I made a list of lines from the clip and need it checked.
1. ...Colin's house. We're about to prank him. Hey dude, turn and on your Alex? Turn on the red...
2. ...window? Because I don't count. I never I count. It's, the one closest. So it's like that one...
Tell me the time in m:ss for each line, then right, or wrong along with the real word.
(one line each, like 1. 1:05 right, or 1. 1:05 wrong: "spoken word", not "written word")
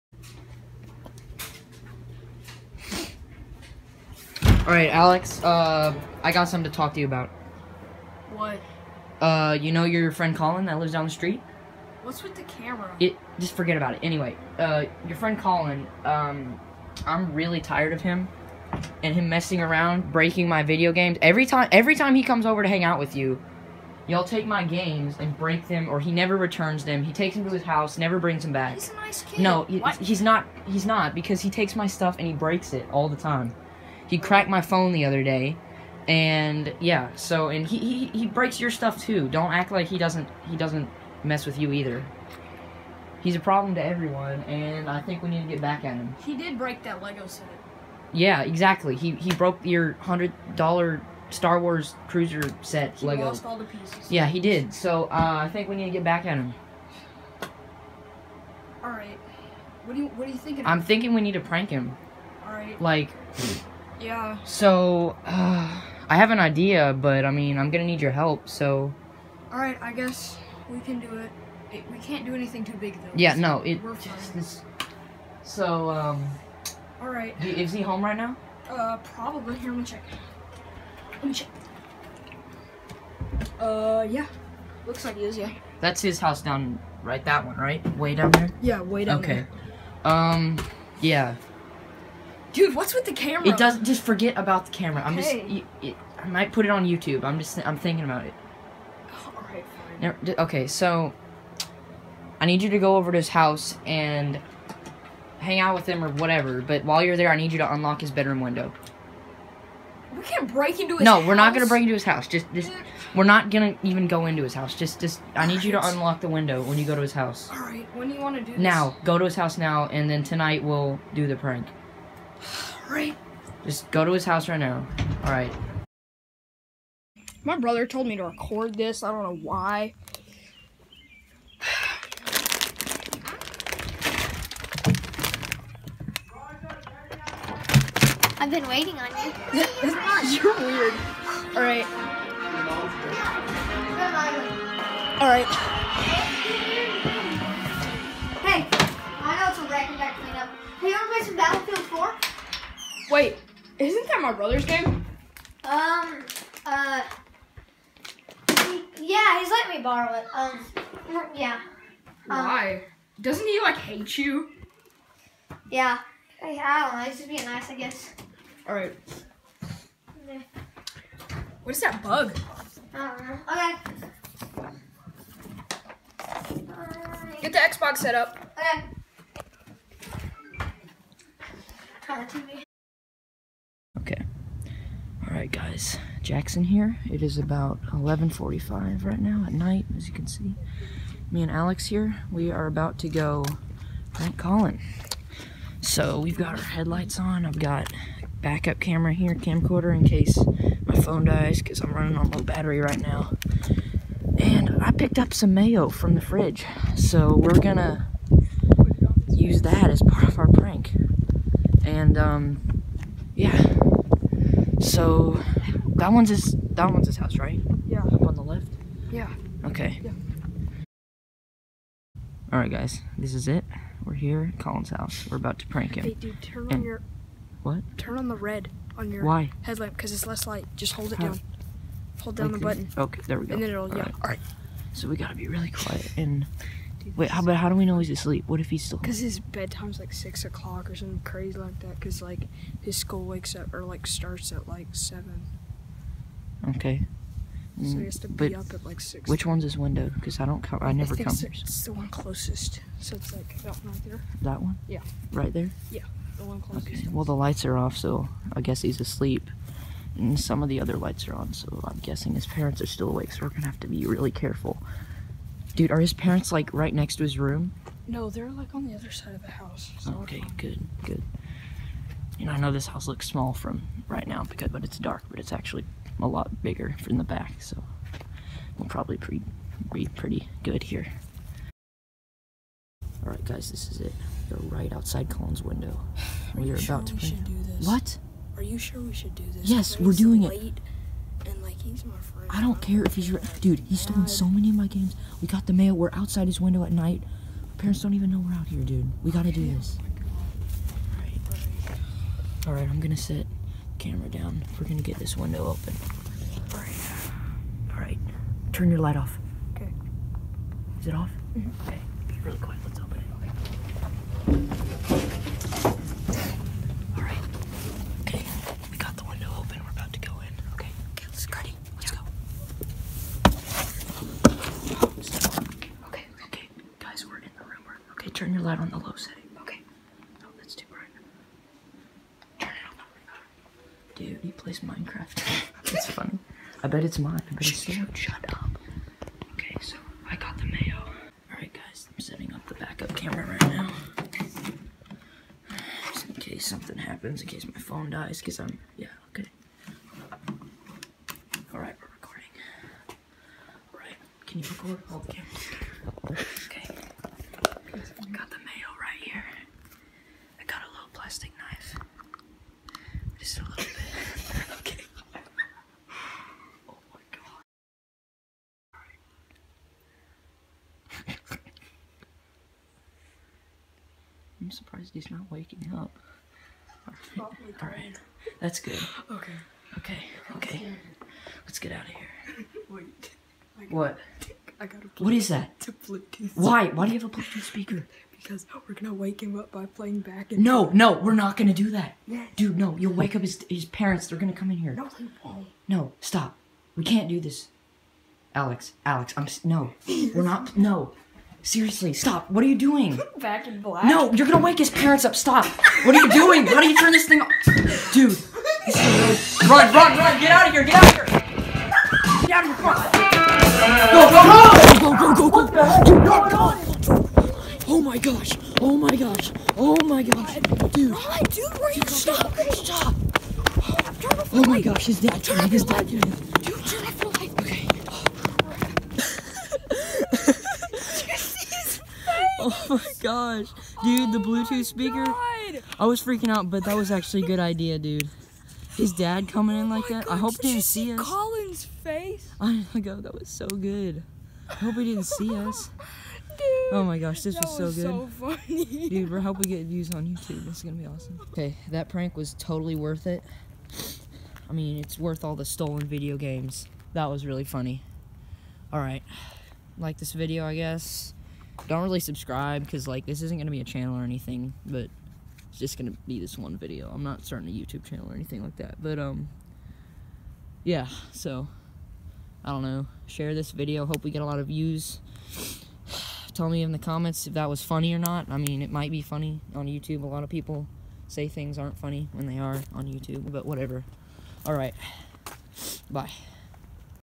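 1. 3:44 wrong: "What", not "Alex"
2. 4:09 right.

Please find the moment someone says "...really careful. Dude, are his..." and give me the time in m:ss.
4:24.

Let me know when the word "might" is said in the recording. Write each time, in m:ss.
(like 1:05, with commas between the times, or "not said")
1:36, 7:58.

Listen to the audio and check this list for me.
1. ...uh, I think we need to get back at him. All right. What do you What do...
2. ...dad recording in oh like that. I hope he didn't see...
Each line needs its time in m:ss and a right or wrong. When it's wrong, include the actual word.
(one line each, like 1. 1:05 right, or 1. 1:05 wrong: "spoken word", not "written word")
1. 0:55 right
2. 7:19 wrong: "coming", not "recording".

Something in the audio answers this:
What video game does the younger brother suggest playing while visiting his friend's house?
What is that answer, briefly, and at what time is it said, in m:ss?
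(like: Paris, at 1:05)
Battlefield 4, at 2:31.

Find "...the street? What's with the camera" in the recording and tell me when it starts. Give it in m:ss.
0:11.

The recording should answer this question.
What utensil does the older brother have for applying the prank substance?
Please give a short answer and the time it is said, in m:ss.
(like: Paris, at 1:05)
Plastic knife, at 6:01.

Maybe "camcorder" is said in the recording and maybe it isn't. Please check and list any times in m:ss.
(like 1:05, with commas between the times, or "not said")
3:19.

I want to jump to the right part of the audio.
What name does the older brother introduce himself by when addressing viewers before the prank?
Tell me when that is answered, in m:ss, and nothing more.
3:06.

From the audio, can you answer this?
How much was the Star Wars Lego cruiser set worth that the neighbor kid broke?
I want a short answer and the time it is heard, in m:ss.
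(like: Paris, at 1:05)
$100, at 0:50.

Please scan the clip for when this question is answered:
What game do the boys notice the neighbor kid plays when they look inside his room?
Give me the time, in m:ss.
5:34.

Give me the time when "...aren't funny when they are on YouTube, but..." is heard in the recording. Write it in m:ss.
8:01.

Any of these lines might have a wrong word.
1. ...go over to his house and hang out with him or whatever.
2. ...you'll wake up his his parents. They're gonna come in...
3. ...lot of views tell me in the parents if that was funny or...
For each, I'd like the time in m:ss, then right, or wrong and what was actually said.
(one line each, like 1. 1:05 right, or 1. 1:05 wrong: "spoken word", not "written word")
1. 1:42 right
2. 6:32 right
3. 7:54 wrong: "comments", not "parents".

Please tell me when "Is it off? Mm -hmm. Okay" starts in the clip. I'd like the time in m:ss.
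5:10.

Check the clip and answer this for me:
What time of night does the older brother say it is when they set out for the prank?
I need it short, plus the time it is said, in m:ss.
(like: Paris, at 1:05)
11:45, at 3:07.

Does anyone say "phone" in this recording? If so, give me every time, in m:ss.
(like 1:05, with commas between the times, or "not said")
0:34, 3:20, 5:47.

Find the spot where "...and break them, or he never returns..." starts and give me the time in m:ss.
0:25.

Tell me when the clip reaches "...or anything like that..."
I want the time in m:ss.
7:48.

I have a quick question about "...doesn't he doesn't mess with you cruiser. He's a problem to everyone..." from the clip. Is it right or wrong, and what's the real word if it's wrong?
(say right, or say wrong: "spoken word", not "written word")
wrong: "either", not "cruiser".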